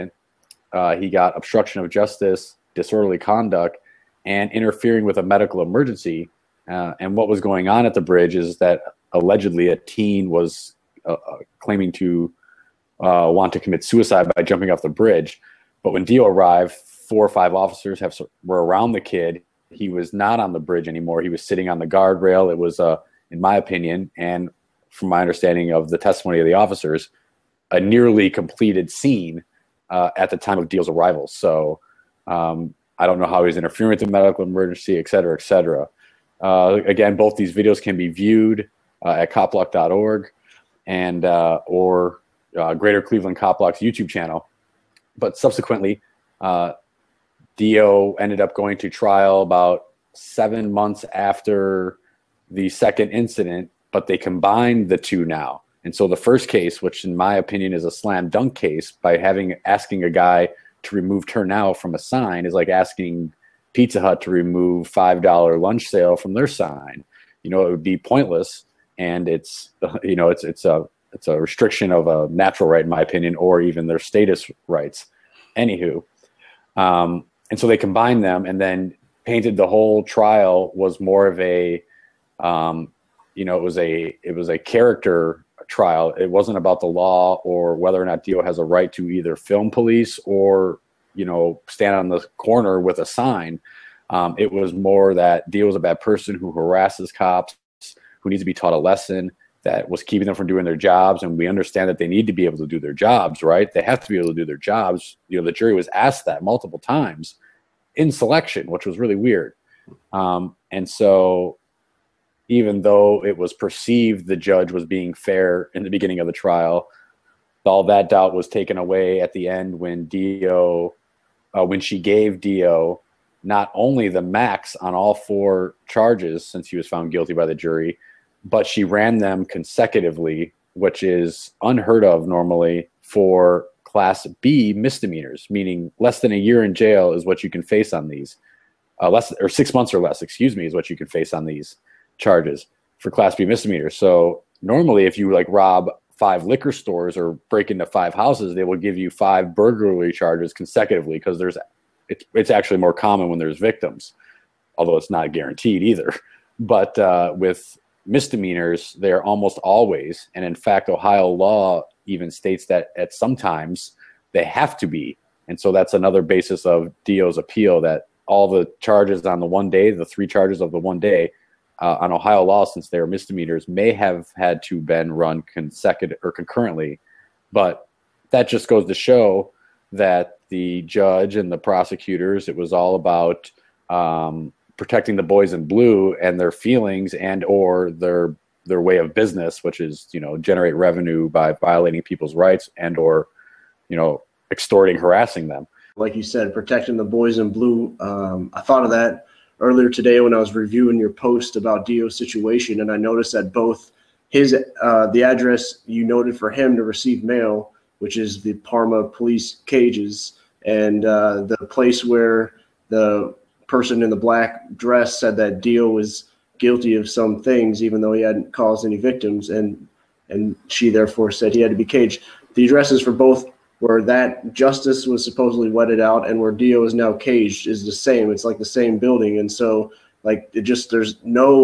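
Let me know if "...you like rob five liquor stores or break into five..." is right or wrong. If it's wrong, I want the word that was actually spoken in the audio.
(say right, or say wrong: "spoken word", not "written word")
right.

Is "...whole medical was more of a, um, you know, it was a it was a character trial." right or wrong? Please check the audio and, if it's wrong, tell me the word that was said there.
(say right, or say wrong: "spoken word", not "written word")
wrong: "trial", not "medical".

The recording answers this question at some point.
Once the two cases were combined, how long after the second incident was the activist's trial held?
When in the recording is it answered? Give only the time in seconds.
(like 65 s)
50 s.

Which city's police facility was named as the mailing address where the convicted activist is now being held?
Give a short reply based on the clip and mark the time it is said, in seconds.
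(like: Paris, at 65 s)
Parma, at 208 s.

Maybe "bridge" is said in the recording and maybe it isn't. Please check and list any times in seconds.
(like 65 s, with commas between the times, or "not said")
8 s, 14 s, 20 s.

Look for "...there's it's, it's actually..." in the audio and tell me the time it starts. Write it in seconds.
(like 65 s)
151 s.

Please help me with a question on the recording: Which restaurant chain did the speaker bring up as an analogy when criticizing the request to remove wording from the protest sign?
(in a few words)
Pizza Hut.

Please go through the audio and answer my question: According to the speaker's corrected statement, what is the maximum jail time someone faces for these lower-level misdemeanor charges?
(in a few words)
6 months.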